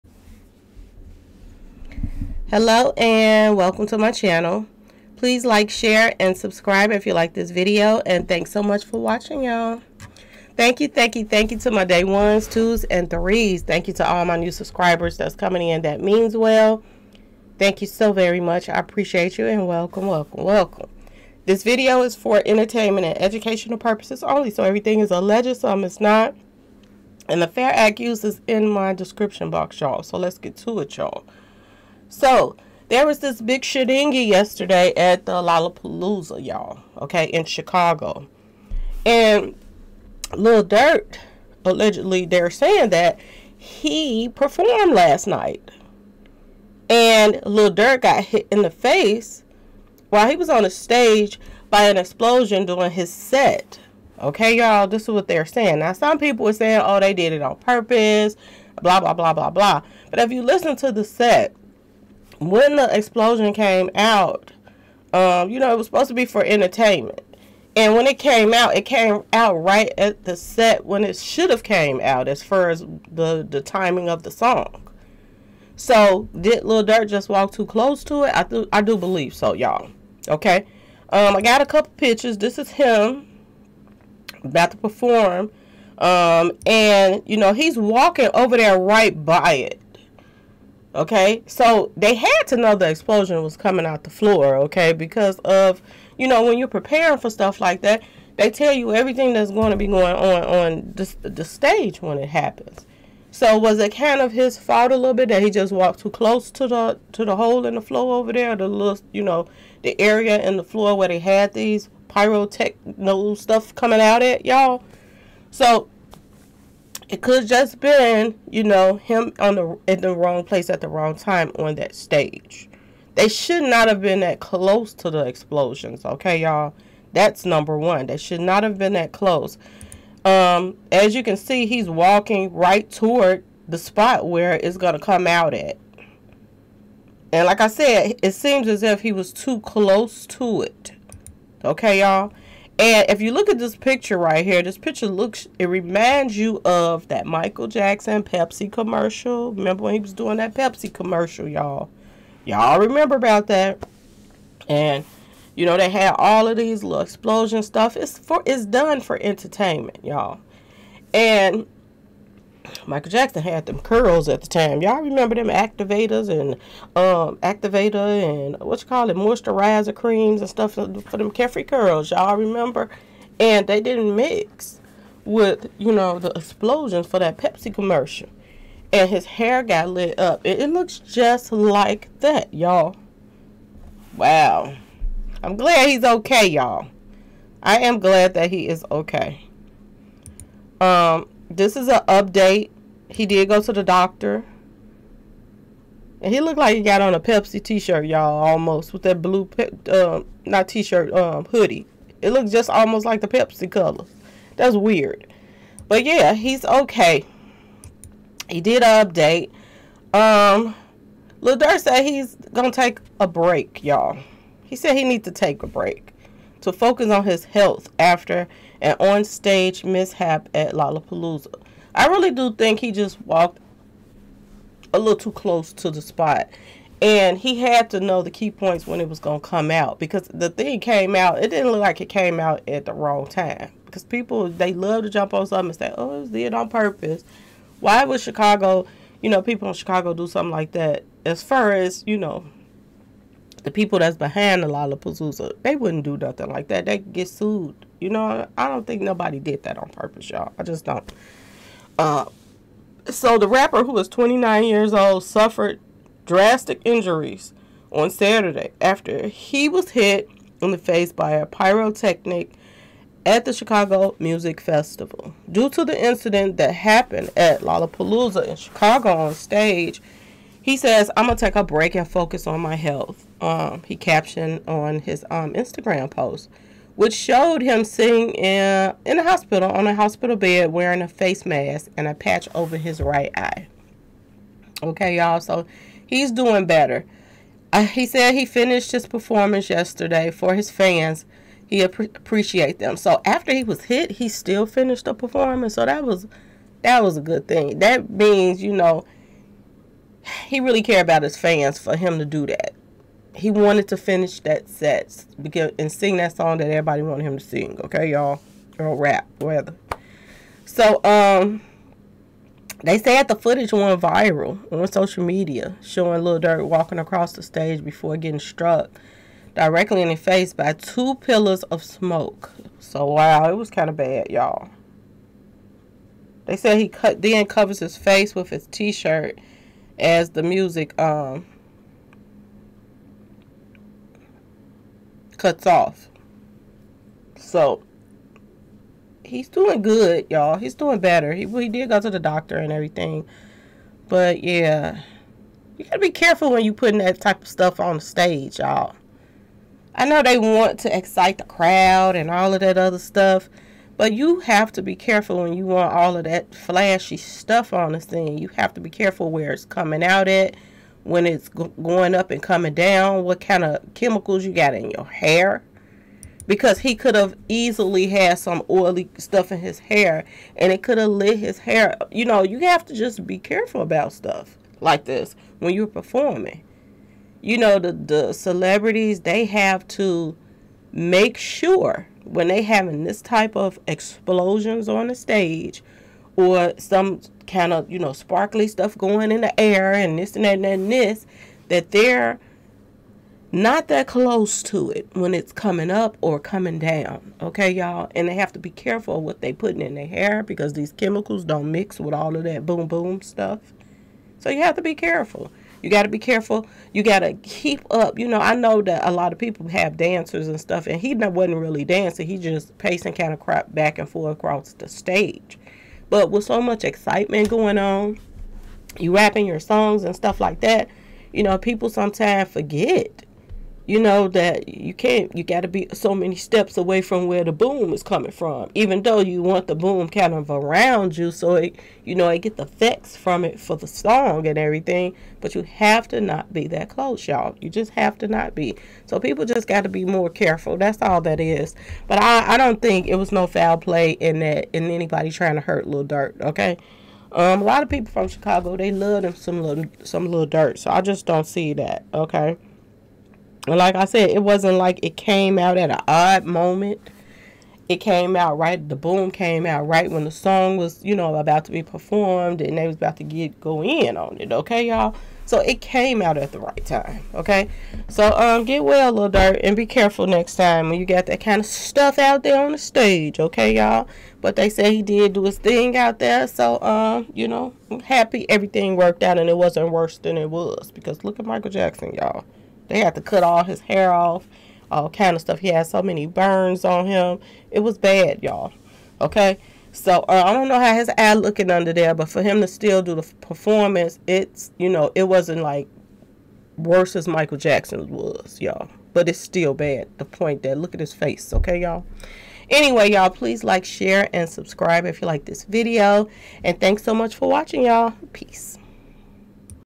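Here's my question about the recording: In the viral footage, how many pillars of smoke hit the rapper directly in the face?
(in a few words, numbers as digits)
2.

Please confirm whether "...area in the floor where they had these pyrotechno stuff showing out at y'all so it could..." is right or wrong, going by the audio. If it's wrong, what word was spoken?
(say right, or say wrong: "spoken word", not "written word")
wrong: "coming", not "showing".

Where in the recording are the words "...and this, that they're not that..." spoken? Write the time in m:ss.
6:30.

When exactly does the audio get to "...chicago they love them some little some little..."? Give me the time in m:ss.
7:28.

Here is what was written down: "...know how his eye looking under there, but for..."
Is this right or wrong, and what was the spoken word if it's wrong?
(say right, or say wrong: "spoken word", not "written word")
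right.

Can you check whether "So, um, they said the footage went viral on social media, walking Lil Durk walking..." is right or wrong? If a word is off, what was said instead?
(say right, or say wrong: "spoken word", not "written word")
wrong: "showing", not "walking".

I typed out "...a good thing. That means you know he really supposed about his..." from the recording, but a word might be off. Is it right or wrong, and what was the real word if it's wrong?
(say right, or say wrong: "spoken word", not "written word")
wrong: "cared", not "supposed".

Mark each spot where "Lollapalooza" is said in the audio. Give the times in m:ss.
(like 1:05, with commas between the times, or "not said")
0:35, 3:40, 4:04, 4:27.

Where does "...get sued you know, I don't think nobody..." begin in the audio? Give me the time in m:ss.
4:06.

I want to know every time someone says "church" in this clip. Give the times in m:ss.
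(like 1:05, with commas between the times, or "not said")
not said.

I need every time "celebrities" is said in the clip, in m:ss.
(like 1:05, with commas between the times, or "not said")
6:18.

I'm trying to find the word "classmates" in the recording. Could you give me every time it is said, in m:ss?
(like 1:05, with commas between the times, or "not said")
not said.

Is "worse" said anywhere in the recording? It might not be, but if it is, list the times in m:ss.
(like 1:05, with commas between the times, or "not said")
7:59, 8:16.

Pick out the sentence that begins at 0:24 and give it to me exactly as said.
So everything is alleged, some is not.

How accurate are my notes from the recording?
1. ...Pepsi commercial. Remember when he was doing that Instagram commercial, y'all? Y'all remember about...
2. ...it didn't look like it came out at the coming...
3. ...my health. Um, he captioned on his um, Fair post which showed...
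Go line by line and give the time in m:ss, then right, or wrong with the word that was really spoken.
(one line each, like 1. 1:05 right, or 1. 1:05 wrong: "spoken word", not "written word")
1. 2:28 wrong: "Pepsi", not "Instagram"
2. 3:51 wrong: "wrong", not "coming"
3. 4:32 wrong: "Instagram", not "Fair".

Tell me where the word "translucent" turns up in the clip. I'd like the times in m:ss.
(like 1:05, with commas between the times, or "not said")
not said.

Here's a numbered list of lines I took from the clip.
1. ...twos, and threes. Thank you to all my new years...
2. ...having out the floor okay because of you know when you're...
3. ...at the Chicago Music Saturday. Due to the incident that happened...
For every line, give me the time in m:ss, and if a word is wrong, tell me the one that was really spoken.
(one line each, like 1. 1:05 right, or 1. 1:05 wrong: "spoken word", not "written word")
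1. 0:12 wrong: "subscribers", not "years"
2. 1:33 wrong: "coming", not "having"
3. 4:23 wrong: "Festival", not "Saturday".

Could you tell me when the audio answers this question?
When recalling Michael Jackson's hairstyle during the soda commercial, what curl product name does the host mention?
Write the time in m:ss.
2:51.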